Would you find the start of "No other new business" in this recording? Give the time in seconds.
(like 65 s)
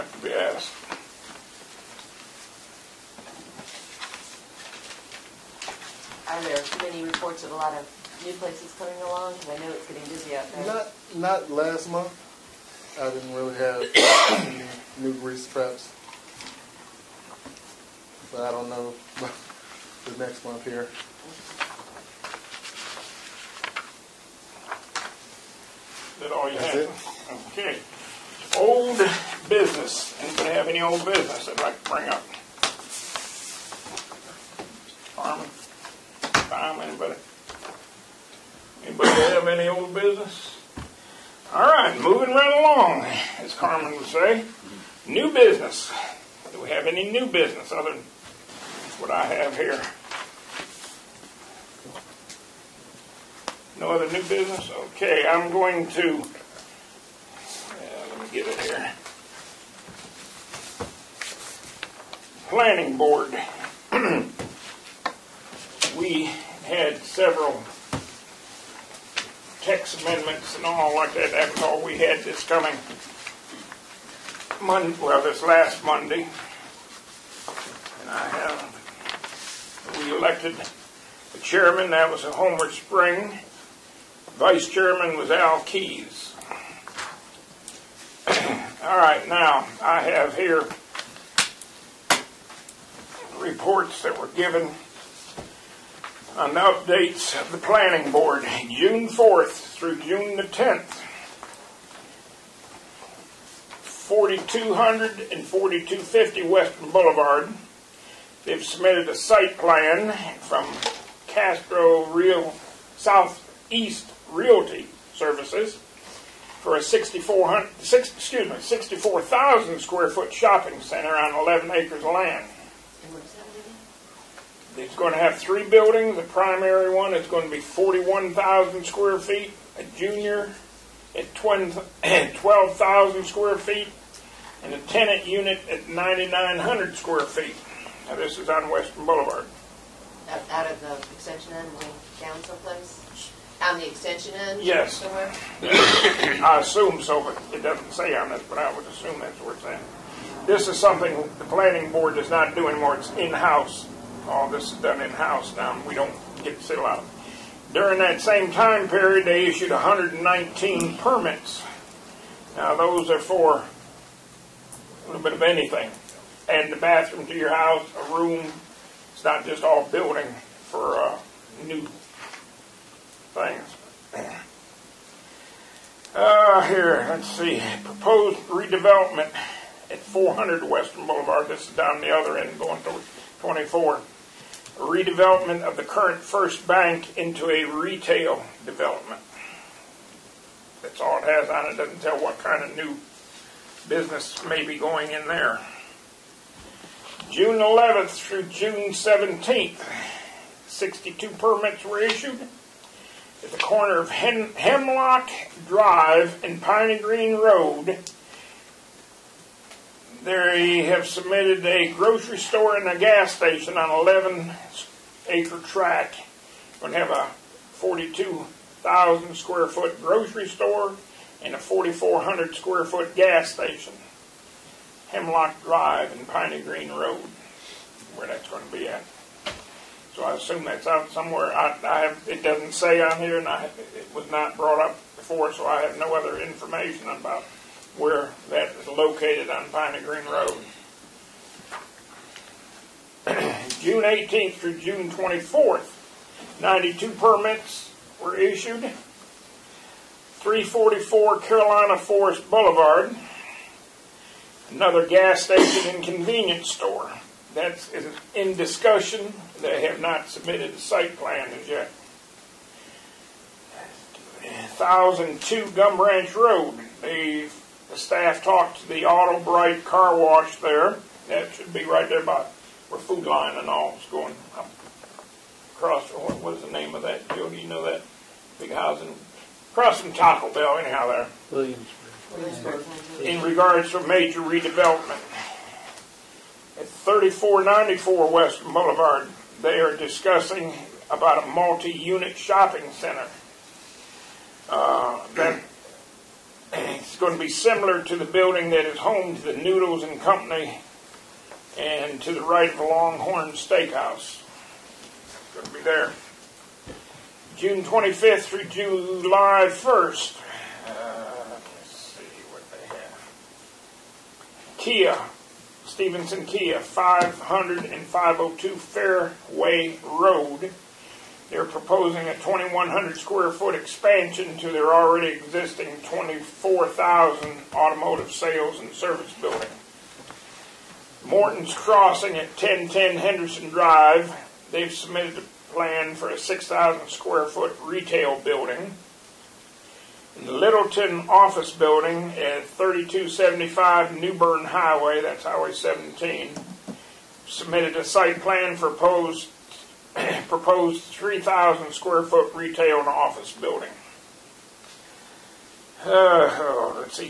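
53 s.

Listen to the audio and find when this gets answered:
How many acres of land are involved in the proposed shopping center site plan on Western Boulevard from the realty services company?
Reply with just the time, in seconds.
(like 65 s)
121 s.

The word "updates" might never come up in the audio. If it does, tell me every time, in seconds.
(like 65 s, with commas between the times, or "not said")
96 s.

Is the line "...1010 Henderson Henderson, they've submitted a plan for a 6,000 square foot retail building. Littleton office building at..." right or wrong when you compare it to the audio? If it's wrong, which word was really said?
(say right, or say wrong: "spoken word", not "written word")
wrong: "Drive", not "Henderson".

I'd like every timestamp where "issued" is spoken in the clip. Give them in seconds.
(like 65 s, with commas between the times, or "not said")
159 s, 202 s, 248 s.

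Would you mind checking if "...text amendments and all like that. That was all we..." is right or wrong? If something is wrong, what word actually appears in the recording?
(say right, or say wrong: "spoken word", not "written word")
right.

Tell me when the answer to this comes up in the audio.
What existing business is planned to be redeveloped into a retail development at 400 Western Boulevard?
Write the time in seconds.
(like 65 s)
186 s.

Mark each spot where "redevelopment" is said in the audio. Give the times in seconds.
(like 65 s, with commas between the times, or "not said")
178 s, 184 s, 284 s.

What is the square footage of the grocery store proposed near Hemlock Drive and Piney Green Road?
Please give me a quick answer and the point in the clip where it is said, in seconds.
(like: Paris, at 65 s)
42,000, at 217 s.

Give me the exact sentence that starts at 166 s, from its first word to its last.
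And the bathroom to your house, a room.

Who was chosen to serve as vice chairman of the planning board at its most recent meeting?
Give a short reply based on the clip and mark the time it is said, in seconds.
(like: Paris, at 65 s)
Al Keys, at 85 s.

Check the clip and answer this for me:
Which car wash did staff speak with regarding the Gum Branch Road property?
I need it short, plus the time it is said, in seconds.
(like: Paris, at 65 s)
Auto Bright, at 269 s.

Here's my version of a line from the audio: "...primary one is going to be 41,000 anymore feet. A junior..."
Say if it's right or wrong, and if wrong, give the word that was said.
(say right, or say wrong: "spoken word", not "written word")
wrong: "square", not "anymore".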